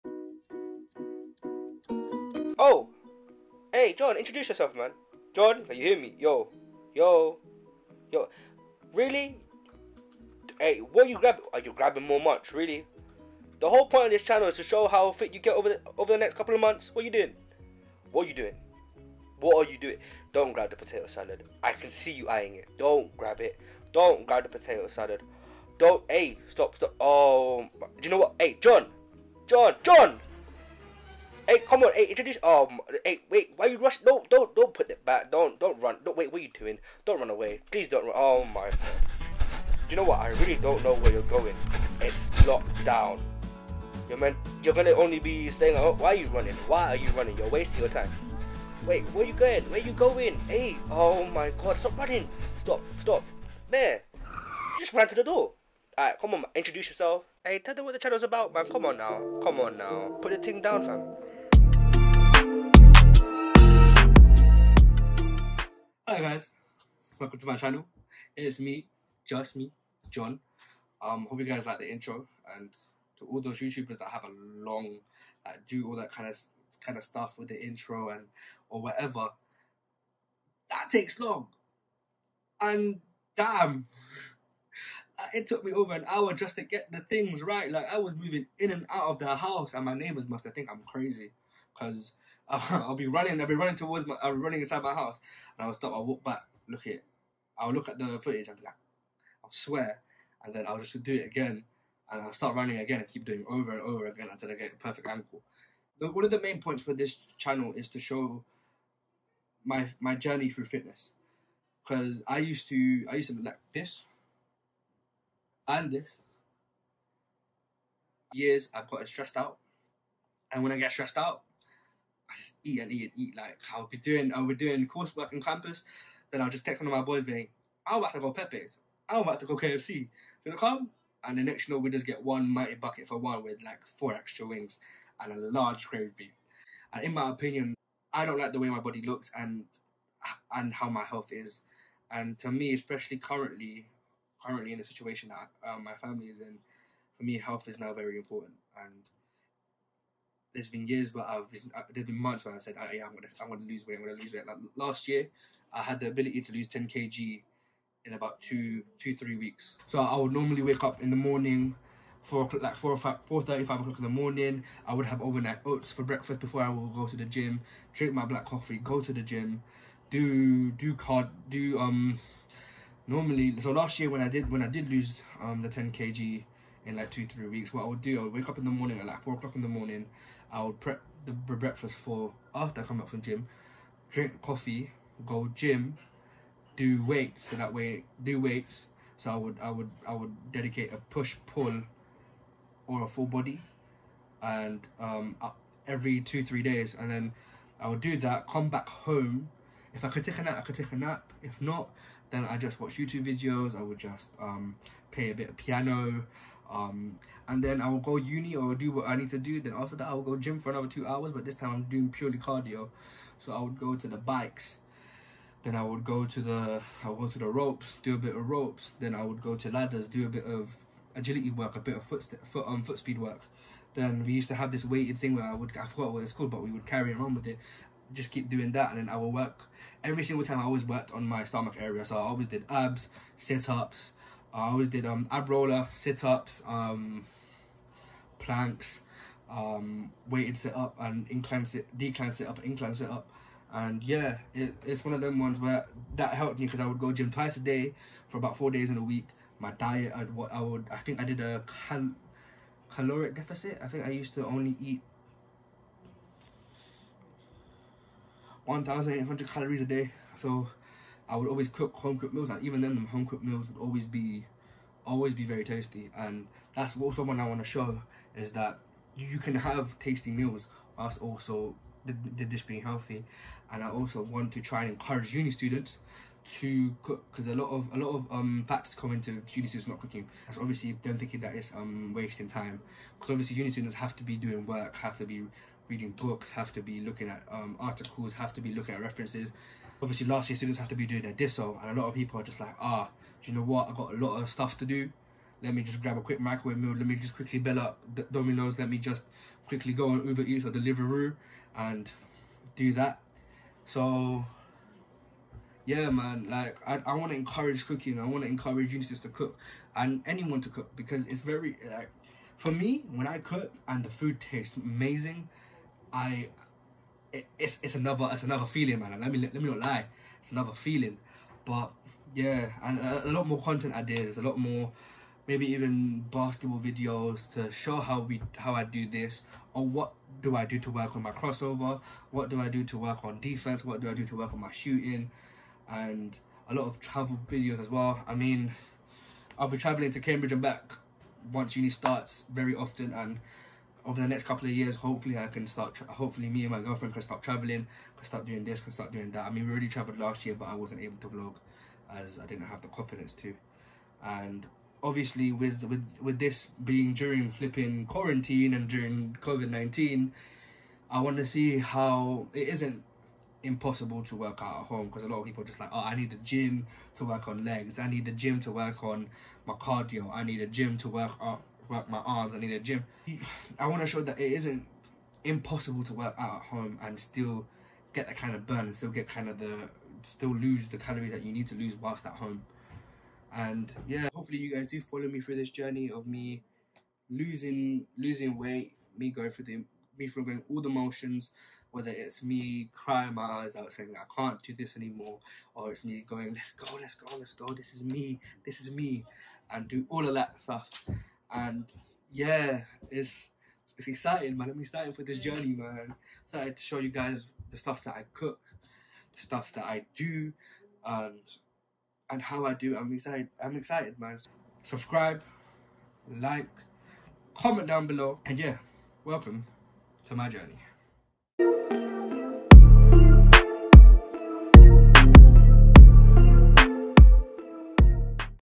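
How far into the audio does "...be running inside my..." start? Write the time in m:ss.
1:34.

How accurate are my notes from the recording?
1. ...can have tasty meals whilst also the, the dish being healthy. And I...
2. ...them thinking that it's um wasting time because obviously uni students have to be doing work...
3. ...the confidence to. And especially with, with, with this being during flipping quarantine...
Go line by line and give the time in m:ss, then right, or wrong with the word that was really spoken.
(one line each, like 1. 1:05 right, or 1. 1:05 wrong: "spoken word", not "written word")
1. 4:29 right
2. 4:41 right
3. 5:52 wrong: "obviously", not "especially".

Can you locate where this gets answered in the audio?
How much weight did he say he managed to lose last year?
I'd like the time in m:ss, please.
2:36.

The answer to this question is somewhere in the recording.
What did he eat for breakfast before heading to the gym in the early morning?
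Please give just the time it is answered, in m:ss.
2:45.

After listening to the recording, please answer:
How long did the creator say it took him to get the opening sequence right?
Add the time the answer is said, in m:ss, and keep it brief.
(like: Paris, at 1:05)
Over an hour, at 1:25.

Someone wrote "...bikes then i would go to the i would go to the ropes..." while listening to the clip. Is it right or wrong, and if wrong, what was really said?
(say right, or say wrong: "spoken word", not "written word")
right.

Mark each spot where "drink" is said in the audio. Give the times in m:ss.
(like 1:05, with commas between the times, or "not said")
2:47, 3:04.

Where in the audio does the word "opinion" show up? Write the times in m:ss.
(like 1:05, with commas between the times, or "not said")
2:17.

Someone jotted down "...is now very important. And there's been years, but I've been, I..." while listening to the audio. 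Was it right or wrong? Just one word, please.
right.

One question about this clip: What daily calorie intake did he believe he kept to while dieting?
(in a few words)
1,800 calories.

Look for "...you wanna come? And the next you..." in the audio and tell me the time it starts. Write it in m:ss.
2:09.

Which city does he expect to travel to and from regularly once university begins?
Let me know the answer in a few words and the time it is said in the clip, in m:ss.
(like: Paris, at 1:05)
Cambridge, at 5:40.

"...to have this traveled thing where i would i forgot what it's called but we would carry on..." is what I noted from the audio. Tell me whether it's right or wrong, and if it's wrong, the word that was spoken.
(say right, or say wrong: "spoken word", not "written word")
wrong: "weighted", not "traveled".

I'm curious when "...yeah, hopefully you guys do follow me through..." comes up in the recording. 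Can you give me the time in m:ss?
6:24.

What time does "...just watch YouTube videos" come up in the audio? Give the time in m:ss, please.
3:22.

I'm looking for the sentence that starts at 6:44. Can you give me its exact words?
I'm excited for this journey, man.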